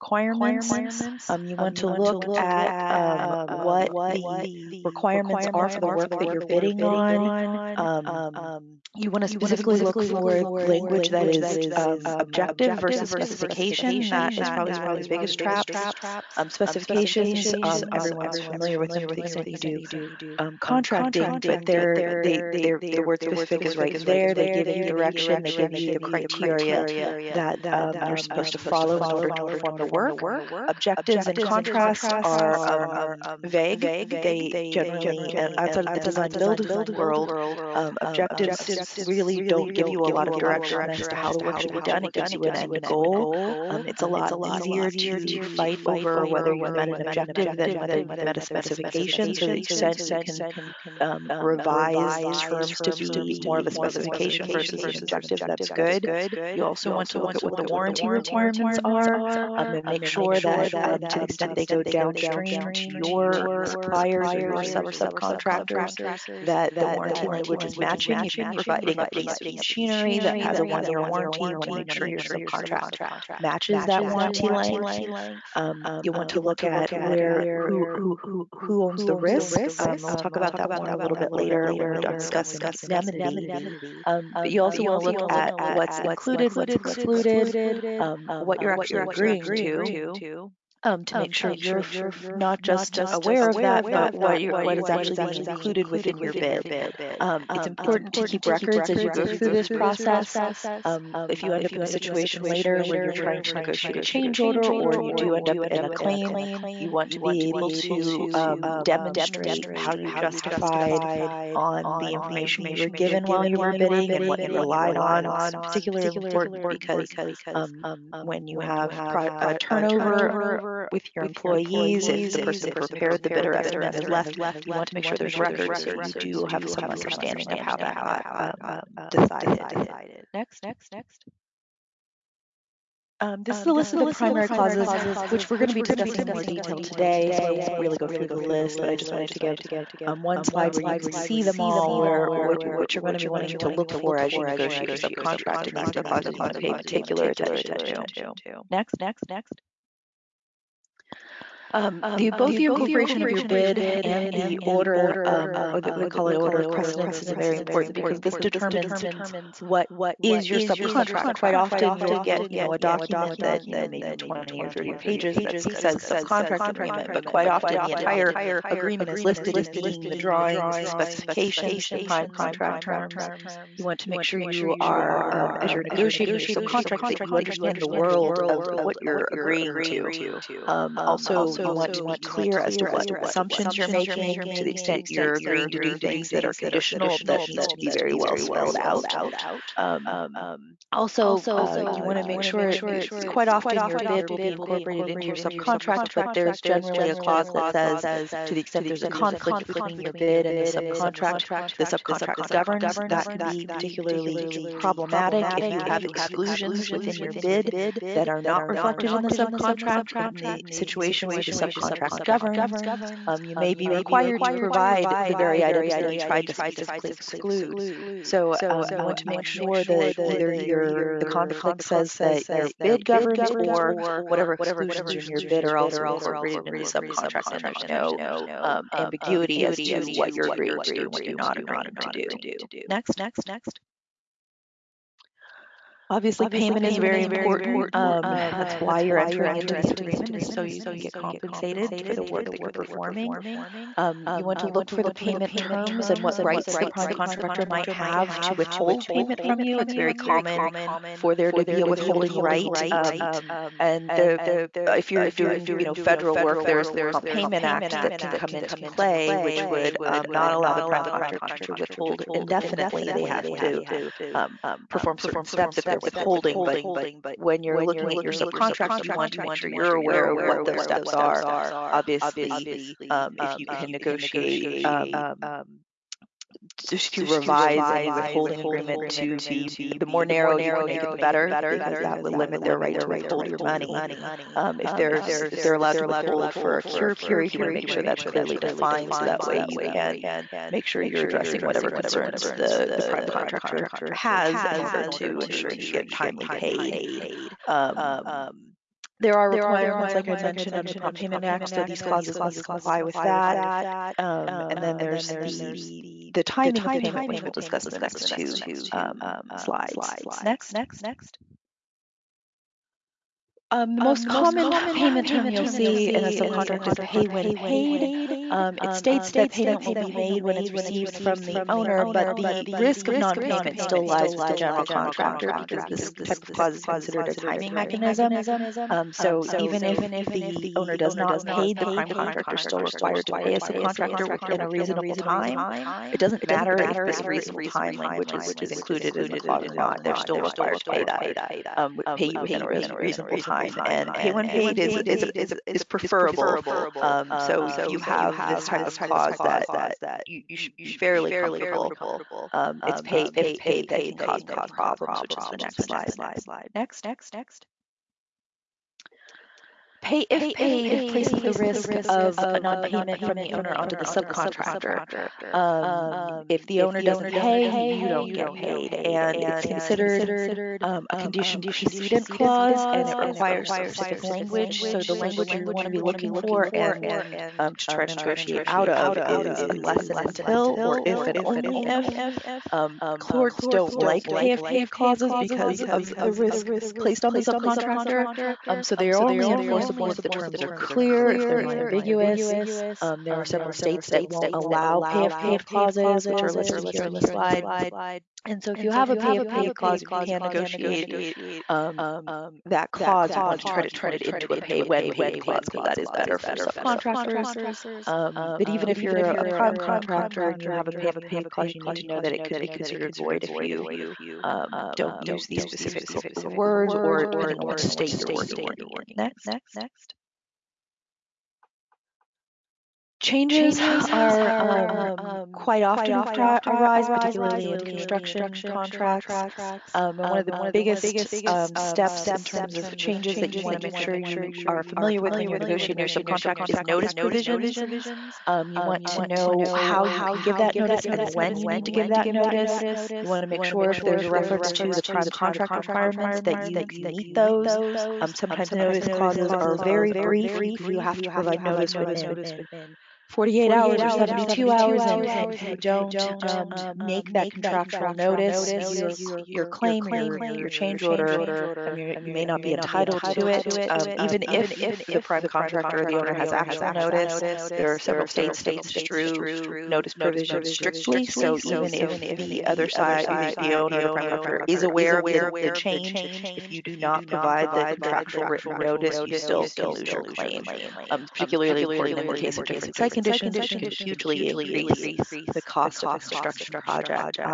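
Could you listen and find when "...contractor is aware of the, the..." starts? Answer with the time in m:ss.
7:54.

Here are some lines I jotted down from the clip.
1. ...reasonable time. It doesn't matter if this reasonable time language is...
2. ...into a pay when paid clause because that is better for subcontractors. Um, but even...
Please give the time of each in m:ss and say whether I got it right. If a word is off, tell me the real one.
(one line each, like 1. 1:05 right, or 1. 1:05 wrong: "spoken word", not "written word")
1. 5:34 right
2. 6:44 right.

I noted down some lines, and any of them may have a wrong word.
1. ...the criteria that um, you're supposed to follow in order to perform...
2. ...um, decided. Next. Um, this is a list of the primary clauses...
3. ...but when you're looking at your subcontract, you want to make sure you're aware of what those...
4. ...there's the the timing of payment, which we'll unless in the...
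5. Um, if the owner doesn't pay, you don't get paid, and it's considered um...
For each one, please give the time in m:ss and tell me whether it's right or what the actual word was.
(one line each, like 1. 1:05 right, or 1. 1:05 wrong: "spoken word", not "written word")
1. 0:25 right
2. 2:08 right
3. 4:26 right
4. 5:04 wrong: "discuss", not "unless"
5. 6:05 right.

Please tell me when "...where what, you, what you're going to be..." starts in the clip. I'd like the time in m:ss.
2:21.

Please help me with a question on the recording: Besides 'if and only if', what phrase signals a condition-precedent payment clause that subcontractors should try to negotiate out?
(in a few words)
unless and until.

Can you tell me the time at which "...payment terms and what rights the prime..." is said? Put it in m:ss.
4:05.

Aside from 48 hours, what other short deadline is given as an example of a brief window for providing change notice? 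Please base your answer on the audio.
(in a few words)
72 hours.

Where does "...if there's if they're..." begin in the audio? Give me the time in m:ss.
4:44.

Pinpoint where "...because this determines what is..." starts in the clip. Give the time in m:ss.
2:37.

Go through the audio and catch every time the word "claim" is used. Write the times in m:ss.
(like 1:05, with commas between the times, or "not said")
1:45, 7:39, 8:00.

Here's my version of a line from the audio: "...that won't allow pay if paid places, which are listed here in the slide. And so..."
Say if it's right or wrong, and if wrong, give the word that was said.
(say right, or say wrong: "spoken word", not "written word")
wrong: "clauses", not "places".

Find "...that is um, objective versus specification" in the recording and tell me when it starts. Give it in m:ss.
0:11.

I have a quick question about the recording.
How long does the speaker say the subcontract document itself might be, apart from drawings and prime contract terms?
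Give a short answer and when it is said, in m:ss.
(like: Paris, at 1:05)
20 or 30 pages, at 2:44.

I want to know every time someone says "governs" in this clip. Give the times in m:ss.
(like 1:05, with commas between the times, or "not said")
3:22, 3:32, 3:43.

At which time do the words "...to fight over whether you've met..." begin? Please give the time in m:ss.
0:44.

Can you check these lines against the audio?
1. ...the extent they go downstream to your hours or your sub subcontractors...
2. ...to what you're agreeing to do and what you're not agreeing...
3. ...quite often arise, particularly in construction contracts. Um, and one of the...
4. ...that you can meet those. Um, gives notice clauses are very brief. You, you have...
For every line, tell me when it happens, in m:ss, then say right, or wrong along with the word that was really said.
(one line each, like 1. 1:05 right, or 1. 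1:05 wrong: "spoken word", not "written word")
1. 1:01 wrong: "suppliers", not "hours"
2. 3:49 right
3. 7:05 right
4. 7:26 wrong: "sometimes", not "gives".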